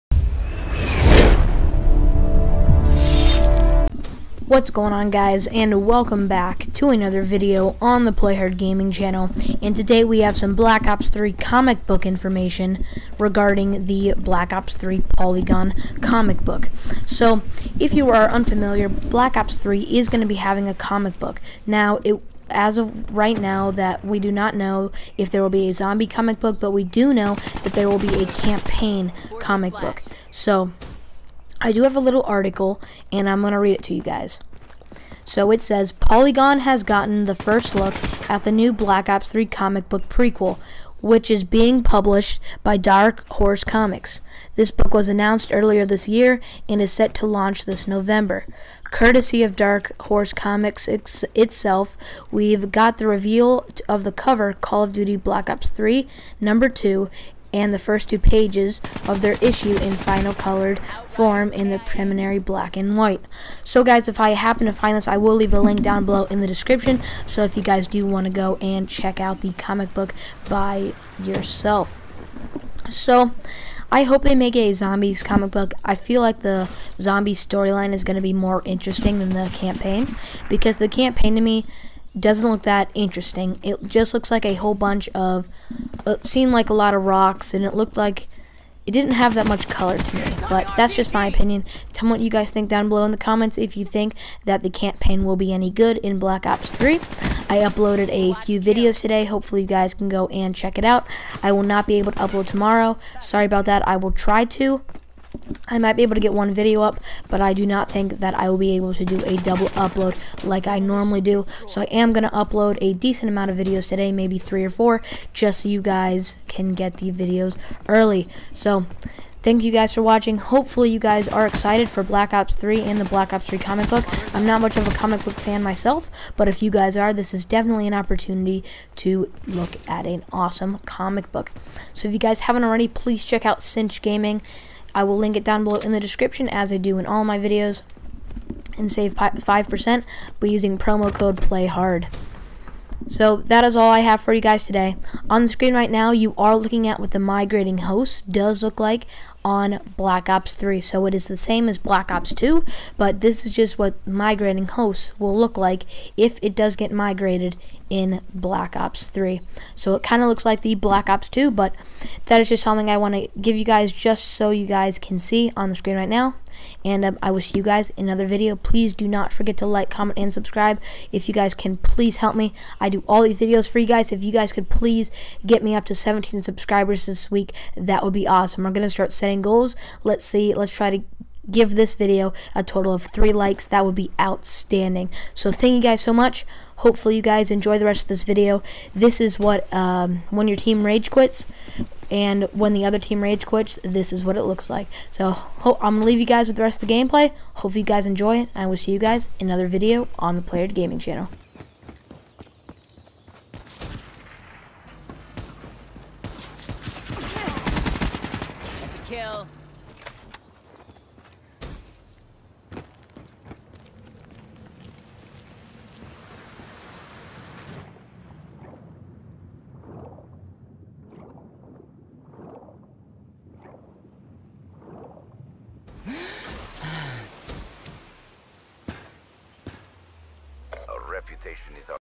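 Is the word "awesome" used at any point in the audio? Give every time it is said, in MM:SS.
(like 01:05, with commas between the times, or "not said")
02:10, 02:58.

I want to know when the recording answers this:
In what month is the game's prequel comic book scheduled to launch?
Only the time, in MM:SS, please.
00:47.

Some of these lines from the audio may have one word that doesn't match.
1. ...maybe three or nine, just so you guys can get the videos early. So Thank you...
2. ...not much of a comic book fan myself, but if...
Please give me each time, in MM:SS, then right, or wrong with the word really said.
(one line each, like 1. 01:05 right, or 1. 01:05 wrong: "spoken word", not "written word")
1. 01:54 wrong: "four", not "nine"
2. 02:04 right.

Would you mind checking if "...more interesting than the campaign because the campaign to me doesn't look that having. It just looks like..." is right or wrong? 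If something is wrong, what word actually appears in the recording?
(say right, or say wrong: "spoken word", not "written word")
wrong: "interesting", not "having".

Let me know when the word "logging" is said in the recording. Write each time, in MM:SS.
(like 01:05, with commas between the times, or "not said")
not said.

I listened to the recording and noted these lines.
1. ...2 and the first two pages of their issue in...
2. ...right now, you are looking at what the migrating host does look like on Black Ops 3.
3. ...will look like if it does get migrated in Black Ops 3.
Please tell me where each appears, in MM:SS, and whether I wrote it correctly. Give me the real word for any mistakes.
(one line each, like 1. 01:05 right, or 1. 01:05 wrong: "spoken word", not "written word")
1. 00:56 right
2. 02:25 right
3. 02:35 right.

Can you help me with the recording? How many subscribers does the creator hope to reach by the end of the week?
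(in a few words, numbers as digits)
17.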